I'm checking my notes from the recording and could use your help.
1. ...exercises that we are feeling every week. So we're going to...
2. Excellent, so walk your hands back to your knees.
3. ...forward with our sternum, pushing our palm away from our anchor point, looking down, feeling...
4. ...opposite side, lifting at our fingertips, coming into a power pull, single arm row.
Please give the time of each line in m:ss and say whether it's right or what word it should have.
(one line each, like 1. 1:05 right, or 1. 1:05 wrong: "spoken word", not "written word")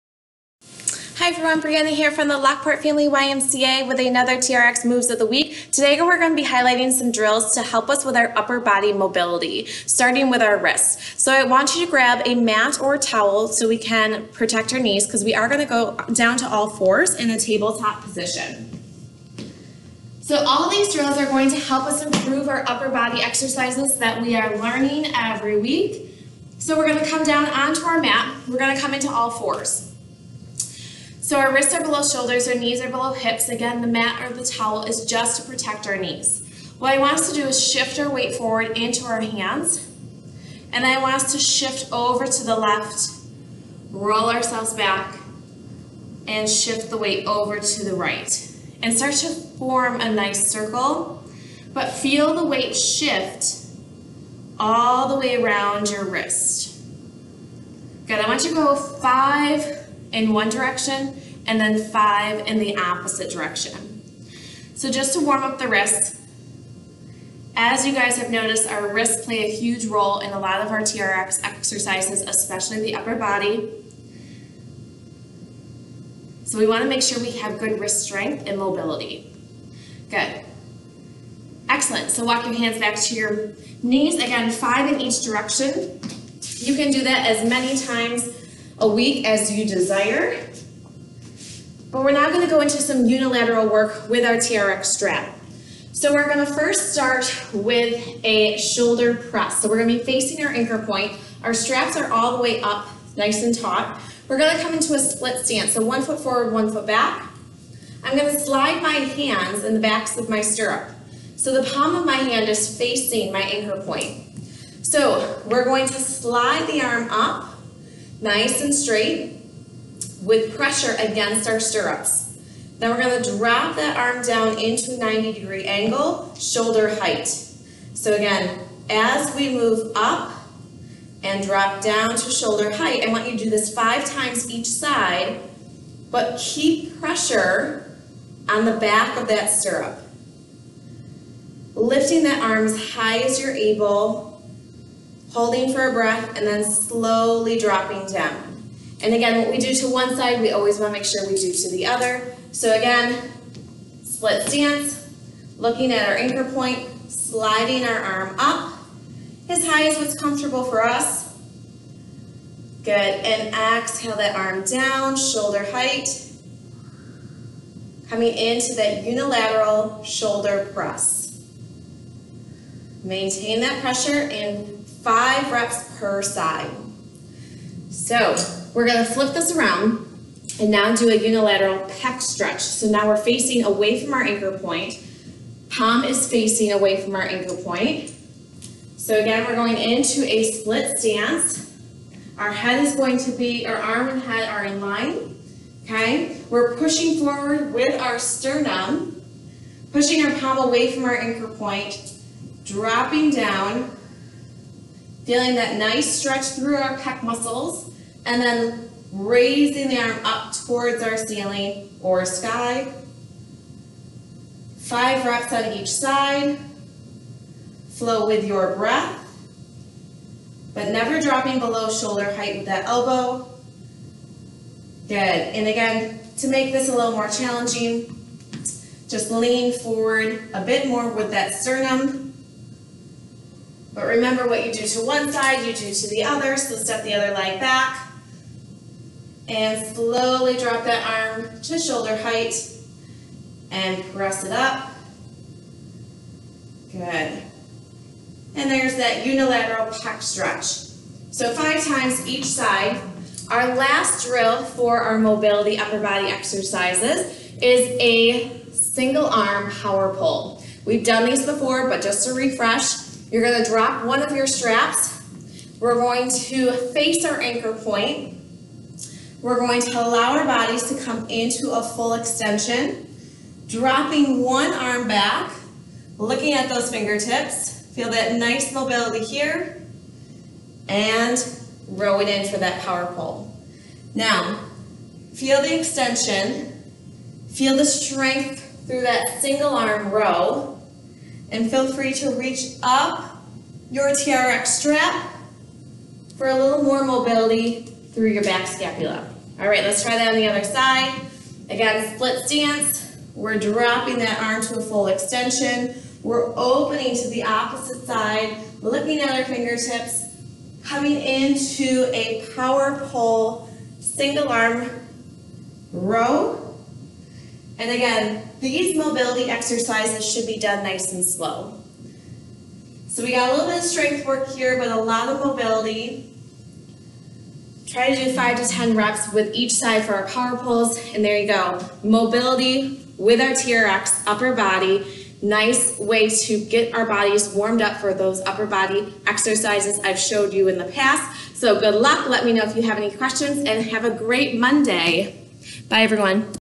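1. 0:23 wrong: "learning", not "feeling"
2. 1:21 right
3. 3:17 wrong: "dropping", not "looking"
4. 5:07 right.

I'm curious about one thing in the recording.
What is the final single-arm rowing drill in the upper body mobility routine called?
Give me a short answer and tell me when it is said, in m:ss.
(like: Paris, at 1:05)
single arm power pull, at 4:18.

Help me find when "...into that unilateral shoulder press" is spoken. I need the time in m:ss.
2:48.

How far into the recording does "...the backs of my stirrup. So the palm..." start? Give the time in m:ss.
1:49.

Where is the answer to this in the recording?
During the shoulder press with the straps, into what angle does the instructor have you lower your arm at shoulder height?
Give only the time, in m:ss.
2:04.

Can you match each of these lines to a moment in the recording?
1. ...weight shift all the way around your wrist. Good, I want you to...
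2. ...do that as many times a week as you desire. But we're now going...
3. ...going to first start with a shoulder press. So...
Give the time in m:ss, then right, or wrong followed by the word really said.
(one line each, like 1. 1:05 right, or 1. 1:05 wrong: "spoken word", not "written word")
1. 0:52 right
2. 1:26 right
3. 1:36 right.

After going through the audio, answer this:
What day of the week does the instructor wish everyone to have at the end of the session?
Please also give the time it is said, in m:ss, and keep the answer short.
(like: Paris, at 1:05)
Monday, at 5:44.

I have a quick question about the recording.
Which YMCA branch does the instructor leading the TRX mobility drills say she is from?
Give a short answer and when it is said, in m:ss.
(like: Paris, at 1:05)
Lockport Family YMCA, at 0:02.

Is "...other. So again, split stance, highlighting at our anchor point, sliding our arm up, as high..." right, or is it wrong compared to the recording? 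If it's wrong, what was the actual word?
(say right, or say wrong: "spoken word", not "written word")
wrong: "looking", not "highlighting".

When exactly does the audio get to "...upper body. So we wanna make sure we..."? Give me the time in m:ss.
1:12.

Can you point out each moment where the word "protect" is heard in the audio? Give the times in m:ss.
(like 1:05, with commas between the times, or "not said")
0:14, 0:35.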